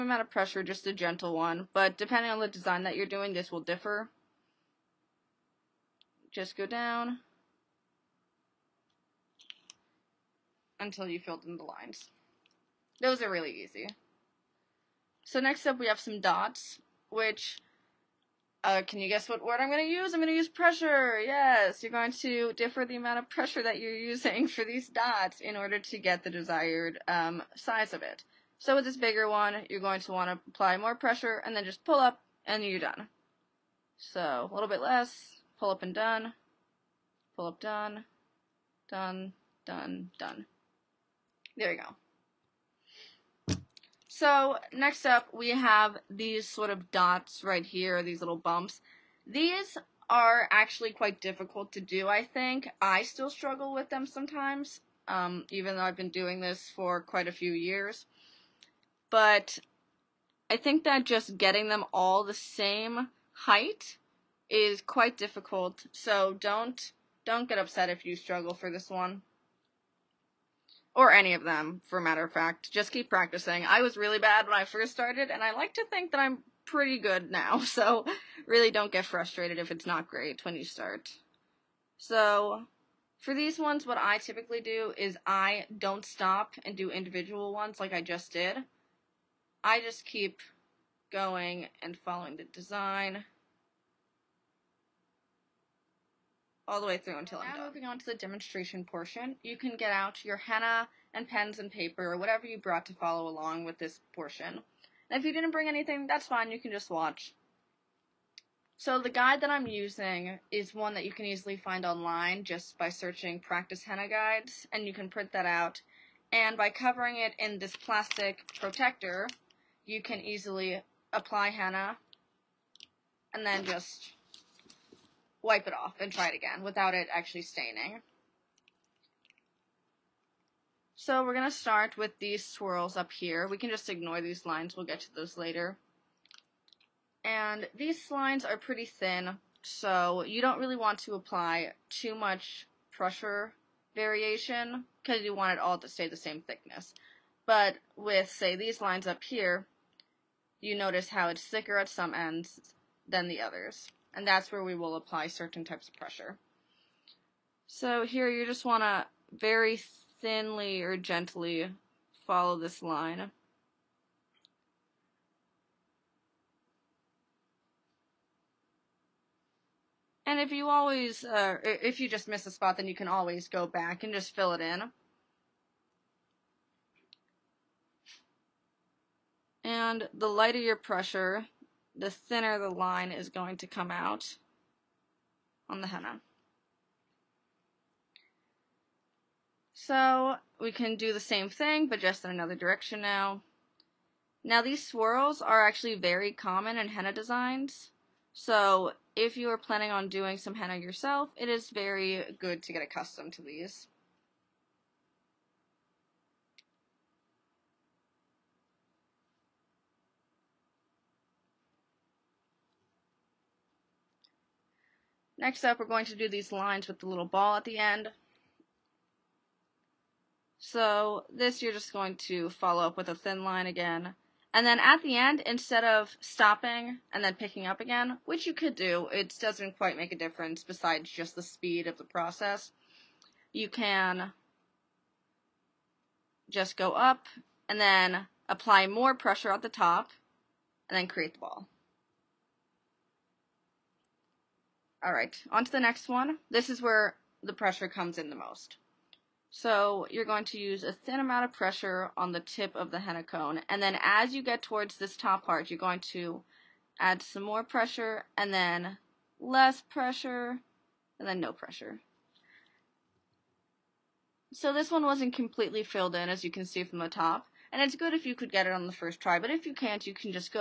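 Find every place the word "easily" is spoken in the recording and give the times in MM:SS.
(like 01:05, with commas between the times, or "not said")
01:51, 02:00.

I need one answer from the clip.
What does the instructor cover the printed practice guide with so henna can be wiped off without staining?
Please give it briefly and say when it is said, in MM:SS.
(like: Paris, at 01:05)
plastic protector, at 01:57.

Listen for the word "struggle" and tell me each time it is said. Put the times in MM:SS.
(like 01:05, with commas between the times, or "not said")
00:53, 01:08.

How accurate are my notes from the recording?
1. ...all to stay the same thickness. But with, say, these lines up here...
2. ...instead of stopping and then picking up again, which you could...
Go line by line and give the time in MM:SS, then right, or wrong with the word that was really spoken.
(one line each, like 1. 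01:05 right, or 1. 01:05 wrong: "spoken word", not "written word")
1. 02:25 right
2. 03:45 right.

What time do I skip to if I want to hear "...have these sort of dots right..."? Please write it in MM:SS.
00:45.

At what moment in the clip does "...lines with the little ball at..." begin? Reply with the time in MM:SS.
03:36.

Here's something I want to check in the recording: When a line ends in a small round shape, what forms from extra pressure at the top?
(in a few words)
the ball.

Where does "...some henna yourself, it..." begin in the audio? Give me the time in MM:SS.
03:20.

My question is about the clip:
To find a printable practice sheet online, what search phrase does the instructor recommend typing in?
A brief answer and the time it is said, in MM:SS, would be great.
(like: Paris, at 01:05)
practice henna guides, at 01:53.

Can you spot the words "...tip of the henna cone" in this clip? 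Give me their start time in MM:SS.
04:12.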